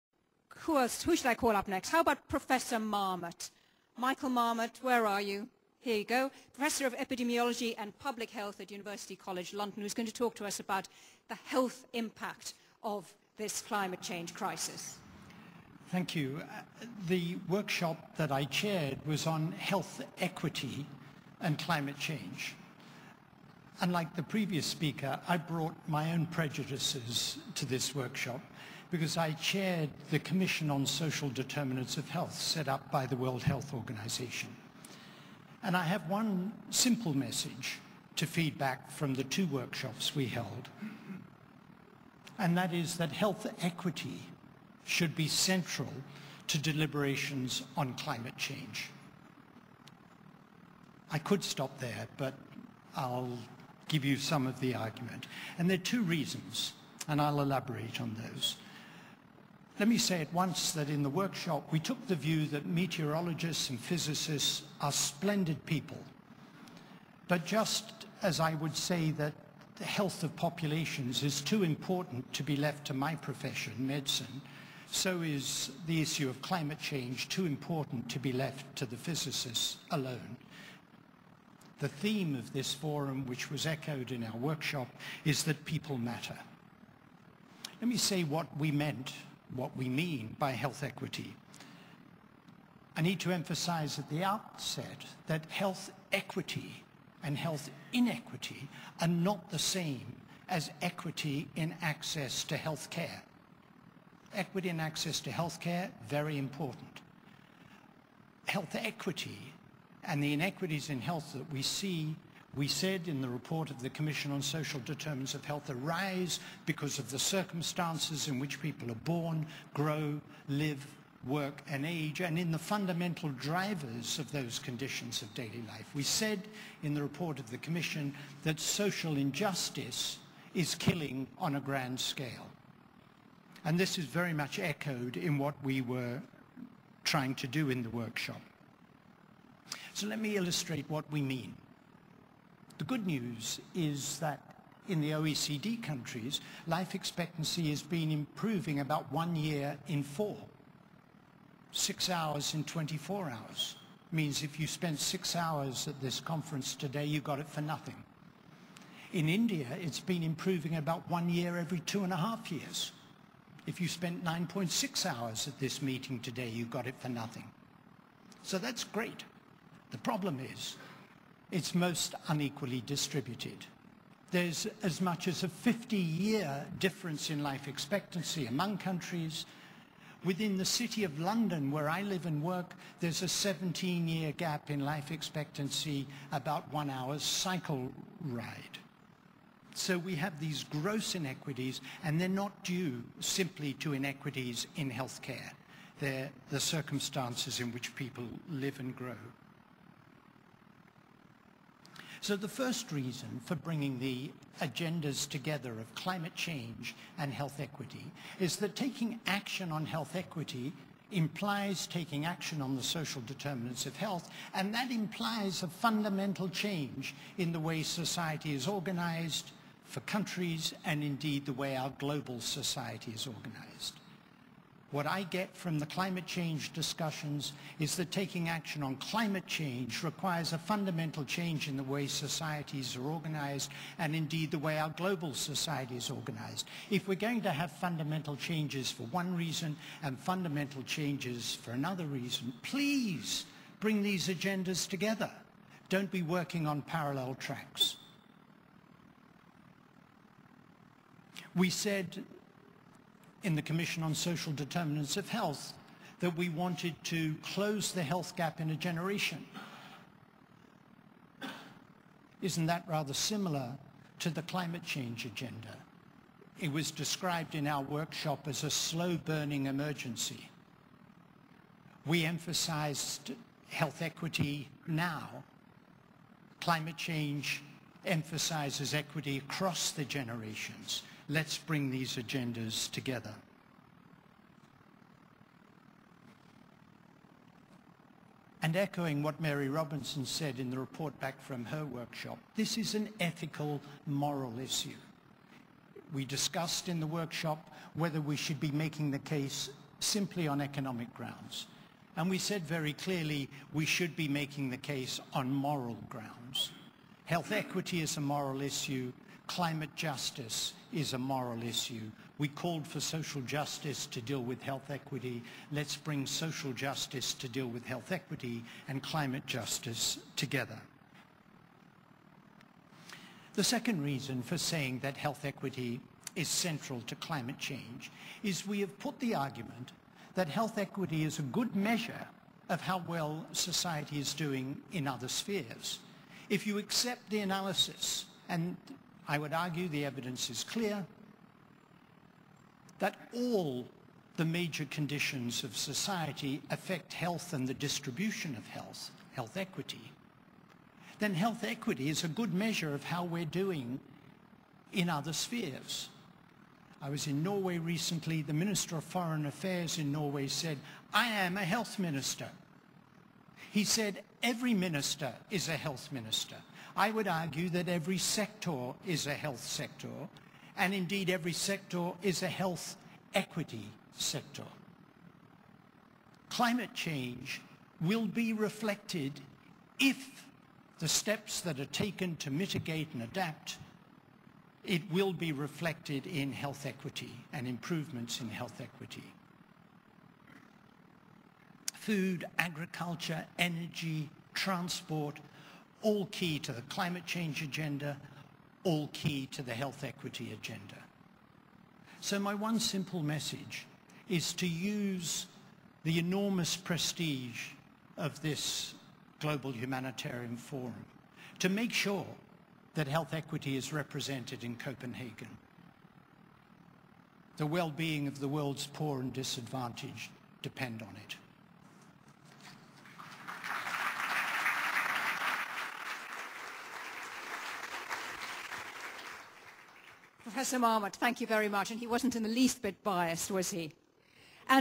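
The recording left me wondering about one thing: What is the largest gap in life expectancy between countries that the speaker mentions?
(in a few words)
50 years.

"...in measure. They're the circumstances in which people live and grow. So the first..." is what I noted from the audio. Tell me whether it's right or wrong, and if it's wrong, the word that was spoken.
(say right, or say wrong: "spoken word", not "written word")
wrong: "healthcare", not "measure".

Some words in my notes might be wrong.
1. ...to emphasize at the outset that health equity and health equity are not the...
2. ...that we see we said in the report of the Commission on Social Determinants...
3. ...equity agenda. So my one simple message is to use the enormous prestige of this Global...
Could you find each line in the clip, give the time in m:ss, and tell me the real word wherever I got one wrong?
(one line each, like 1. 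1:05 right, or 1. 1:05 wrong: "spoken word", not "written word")
1. 1:33 wrong: "inequity", not "equity"
2. 1:51 right
3. 6:40 right.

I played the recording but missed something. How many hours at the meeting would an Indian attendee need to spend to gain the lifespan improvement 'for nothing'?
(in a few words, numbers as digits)
9.6.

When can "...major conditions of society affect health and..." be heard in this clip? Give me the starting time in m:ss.
5:44.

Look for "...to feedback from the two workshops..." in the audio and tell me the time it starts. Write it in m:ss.
0:38.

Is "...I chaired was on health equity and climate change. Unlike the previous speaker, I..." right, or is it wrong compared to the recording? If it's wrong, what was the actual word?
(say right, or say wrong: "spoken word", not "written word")
right.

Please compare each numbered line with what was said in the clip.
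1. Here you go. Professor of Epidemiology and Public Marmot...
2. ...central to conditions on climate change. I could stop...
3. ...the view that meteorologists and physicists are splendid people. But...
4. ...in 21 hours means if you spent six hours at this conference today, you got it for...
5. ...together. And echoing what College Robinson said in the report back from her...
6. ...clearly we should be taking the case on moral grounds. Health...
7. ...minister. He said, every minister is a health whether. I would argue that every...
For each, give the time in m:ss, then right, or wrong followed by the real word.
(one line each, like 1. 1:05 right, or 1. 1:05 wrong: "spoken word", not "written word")
1. 0:05 wrong: "Health", not "Marmot"
2. 0:45 wrong: "deliberations", not "conditions"
3. 1:02 right
4. 2:32 wrong: "24", not "21"
5. 4:42 wrong: "Mary", not "College"
6. 5:02 wrong: "making", not "taking"
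7. 6:01 wrong: "minister", not "whether".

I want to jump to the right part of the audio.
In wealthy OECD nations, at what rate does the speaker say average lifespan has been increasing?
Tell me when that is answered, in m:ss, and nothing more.
2:29.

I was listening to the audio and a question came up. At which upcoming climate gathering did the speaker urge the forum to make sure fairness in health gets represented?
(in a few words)
Copenhagen.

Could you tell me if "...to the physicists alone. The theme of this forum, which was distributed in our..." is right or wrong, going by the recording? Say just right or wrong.
wrong.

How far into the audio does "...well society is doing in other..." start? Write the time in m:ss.
5:33.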